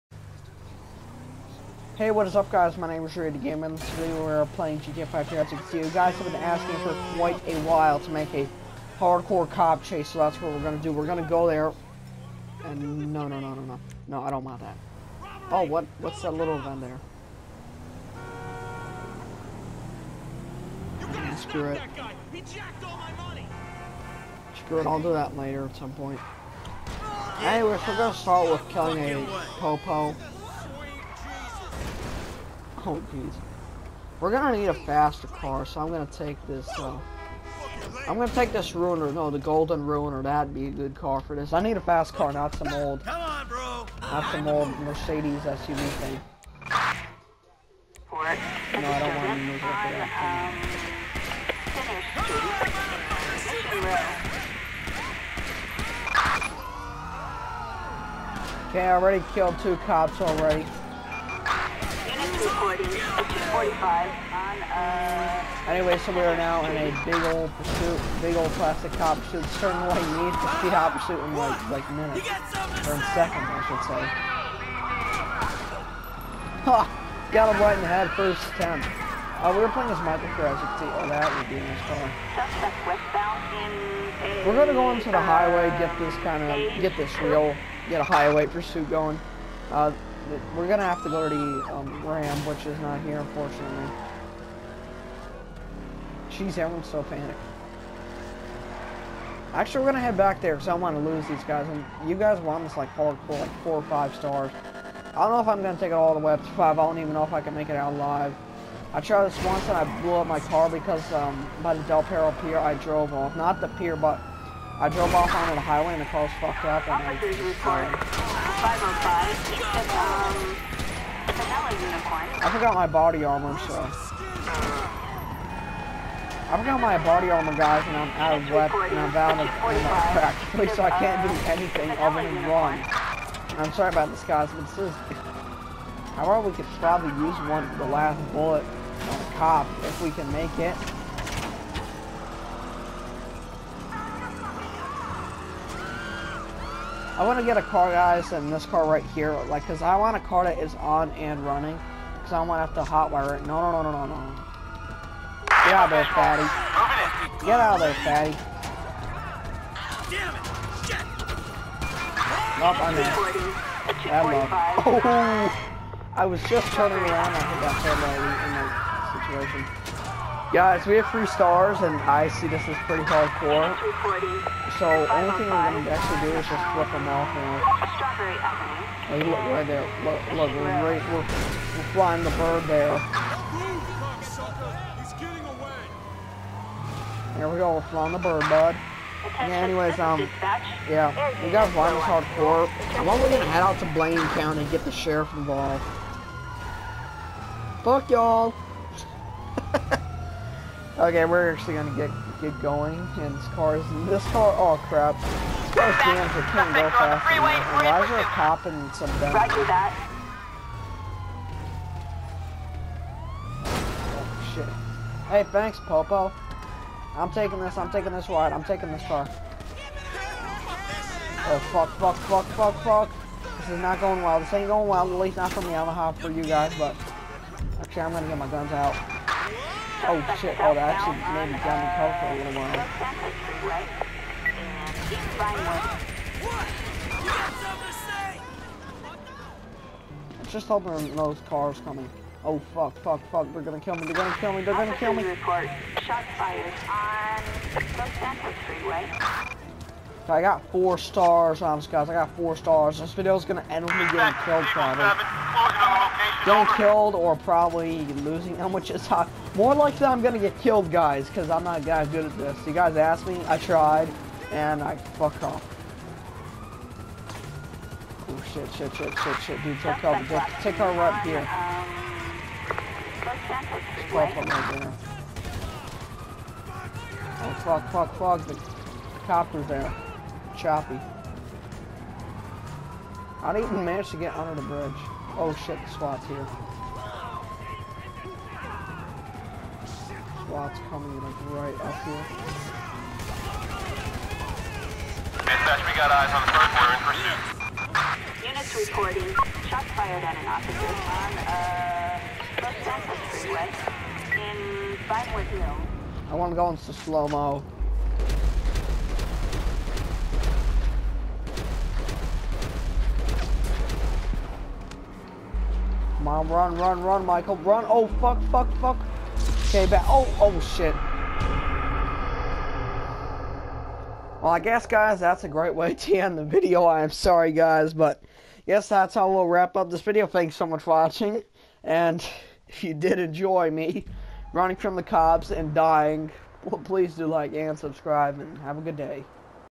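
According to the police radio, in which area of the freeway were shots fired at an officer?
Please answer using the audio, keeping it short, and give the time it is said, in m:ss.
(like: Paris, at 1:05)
Vinewood Hills, at 5:05.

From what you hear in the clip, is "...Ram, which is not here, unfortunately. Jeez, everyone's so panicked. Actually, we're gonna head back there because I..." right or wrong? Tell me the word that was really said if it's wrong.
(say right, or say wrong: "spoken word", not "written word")
right.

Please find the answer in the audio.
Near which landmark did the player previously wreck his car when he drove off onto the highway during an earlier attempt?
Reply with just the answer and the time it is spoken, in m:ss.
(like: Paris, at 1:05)
Del Perro Pier, at 1:51.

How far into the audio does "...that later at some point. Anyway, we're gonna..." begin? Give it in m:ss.
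0:25.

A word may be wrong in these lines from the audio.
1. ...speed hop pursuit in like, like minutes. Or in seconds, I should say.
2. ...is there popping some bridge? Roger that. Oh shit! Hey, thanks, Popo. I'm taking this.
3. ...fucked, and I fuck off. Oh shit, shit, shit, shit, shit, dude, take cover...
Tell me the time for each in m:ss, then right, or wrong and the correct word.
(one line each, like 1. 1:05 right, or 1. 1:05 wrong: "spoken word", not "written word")
1. 1:10 right
2. 3:28 wrong: "damage", not "bridge"
3. 4:23 wrong: "tried", not "fucked".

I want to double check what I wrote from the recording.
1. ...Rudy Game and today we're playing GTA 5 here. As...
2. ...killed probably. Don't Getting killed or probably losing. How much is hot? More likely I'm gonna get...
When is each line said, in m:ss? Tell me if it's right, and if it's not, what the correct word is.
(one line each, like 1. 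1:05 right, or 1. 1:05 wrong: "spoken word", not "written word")
1. 0:03 right
2. 4:14 right.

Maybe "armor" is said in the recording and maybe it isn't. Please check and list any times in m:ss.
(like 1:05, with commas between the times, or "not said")
2:03, 2:07.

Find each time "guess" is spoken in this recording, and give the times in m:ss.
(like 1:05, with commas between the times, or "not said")
5:24.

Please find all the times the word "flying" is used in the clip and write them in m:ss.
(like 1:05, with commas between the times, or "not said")
3:01, 3:07.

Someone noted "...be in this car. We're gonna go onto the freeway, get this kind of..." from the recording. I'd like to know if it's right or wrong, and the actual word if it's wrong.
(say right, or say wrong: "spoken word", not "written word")
wrong: "highway", not "freeway".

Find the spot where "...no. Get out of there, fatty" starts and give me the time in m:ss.
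2:34.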